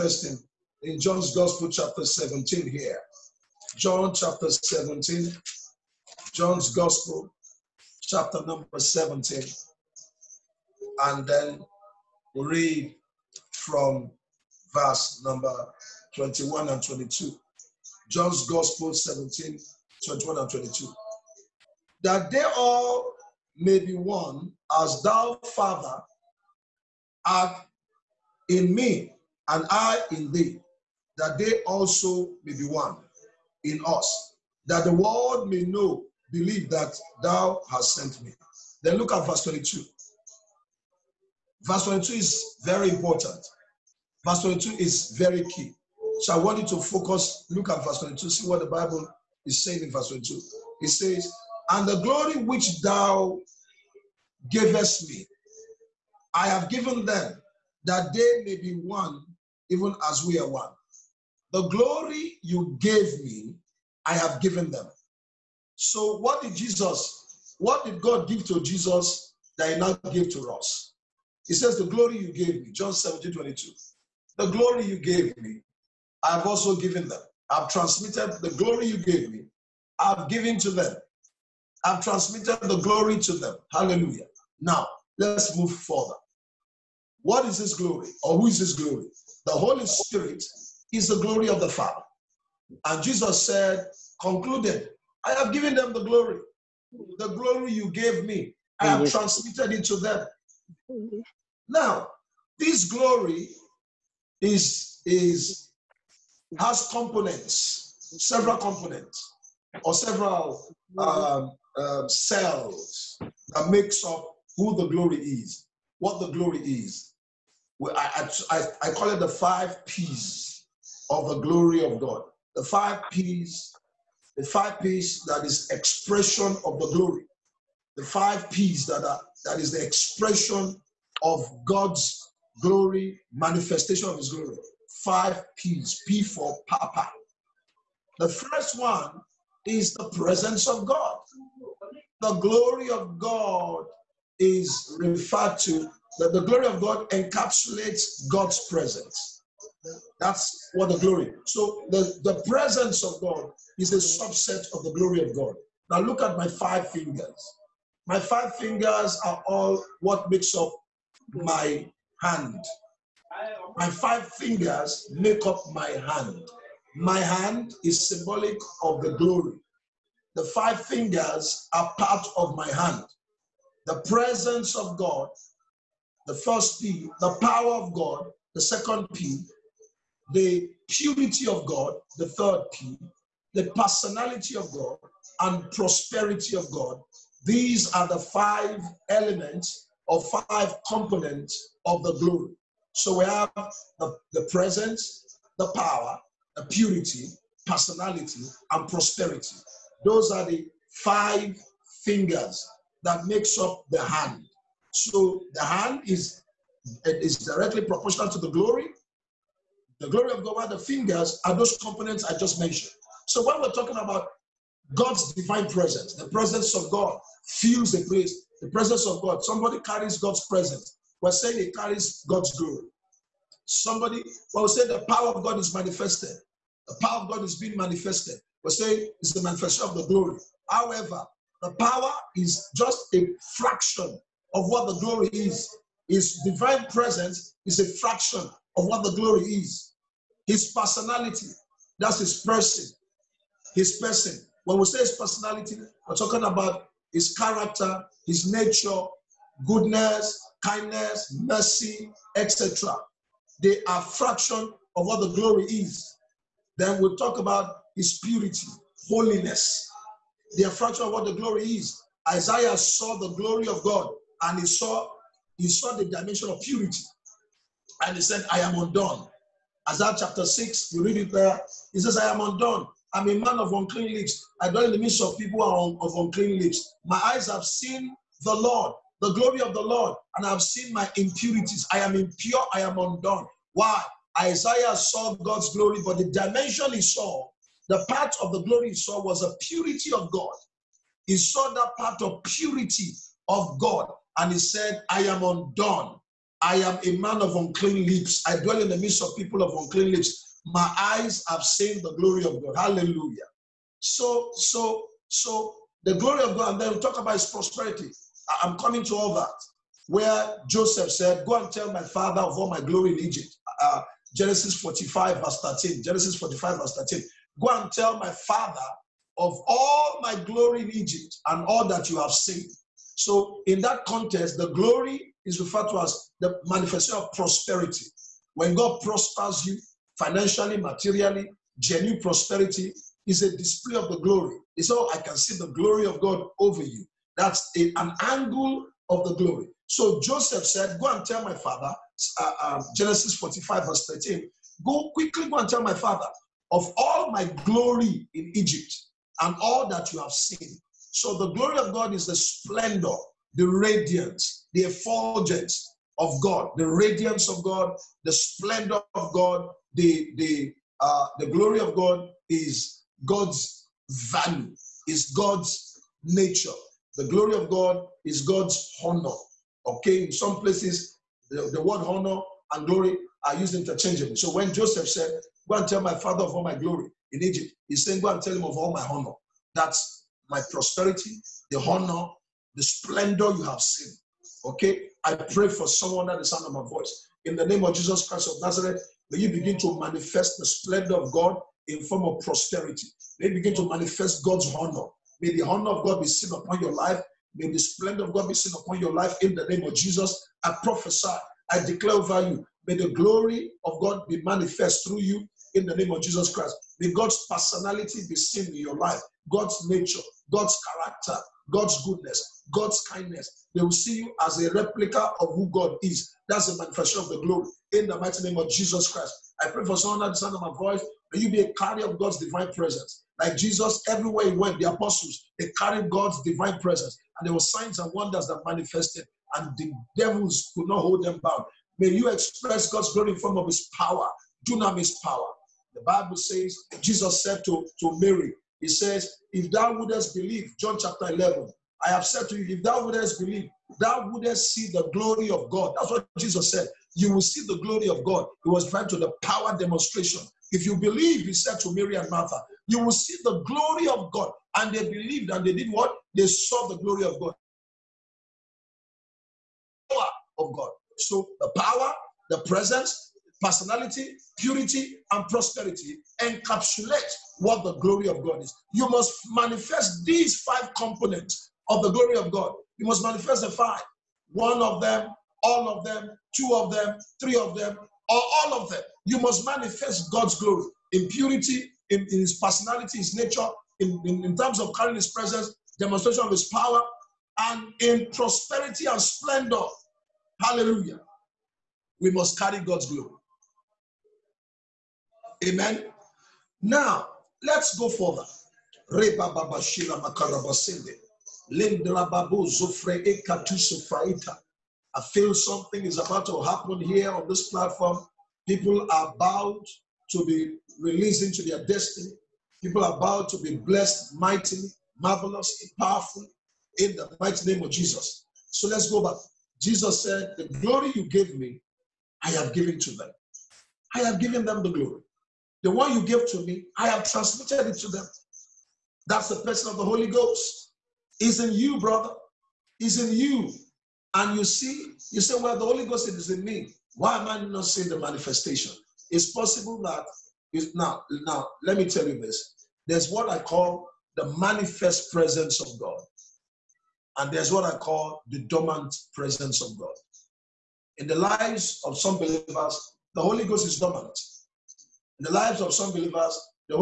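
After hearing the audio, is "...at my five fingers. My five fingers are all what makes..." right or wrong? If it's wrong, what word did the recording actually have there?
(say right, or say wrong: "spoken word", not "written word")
right.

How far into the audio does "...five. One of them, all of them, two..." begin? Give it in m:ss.
7:53.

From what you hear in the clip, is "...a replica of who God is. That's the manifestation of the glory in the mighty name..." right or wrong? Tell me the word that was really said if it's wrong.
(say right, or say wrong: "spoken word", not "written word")
right.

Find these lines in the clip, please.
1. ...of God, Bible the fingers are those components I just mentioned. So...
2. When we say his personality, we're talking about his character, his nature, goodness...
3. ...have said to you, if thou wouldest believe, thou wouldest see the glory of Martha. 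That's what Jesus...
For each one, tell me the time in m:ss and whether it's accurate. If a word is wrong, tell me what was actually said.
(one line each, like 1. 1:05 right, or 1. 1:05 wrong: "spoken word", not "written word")
1. 3:30 wrong: "While", not "Bible"
2. 4:04 right
3. 7:22 wrong: "God", not "Martha".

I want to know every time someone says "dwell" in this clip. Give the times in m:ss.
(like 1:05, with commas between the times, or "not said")
4:34, 4:58.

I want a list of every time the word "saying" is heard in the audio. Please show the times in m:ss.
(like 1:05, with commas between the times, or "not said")
0:49, 3:41, 3:48, 6:18.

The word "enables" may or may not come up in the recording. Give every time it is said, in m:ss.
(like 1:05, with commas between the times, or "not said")
not said.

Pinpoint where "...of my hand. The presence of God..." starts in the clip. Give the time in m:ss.
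2:52.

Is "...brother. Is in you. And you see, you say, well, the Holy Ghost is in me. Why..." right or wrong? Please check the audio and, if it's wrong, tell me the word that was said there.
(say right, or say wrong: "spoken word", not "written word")
right.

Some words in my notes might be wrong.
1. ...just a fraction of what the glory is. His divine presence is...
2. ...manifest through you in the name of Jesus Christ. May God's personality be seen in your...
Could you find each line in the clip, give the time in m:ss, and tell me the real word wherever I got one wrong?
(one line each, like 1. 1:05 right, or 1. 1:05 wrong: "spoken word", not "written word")
1. 3:52 right
2. 6:44 right.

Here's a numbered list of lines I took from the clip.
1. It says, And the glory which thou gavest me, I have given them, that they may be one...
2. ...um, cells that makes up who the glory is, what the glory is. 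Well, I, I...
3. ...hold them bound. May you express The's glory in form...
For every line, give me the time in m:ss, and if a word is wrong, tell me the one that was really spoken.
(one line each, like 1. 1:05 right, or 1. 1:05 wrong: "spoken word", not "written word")
1. 0:50 right
2. 1:51 right
3. 7:11 wrong: "God", not "The".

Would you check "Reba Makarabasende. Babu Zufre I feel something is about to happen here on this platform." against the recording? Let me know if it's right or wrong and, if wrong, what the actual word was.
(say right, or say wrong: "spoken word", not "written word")
right.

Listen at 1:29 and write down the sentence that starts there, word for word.
The Holy Spirit is the glory of the Father.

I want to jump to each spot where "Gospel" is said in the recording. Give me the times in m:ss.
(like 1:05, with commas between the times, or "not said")
0:01, 0:06, 0:18.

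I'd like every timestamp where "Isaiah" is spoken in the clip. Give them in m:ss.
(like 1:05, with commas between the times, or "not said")
4:22, 4:29, 4:44.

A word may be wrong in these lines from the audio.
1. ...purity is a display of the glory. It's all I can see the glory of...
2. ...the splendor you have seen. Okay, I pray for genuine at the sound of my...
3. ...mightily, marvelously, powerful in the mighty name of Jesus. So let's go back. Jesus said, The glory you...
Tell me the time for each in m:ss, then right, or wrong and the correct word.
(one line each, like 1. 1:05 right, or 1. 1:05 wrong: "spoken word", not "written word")
1. 5:32 wrong: "prosperity", not "purity"
2. 6:22 wrong: "someone", not "genuine"
3. 8:34 right.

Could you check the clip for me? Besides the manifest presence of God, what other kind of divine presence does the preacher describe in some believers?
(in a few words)
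Dormant presence.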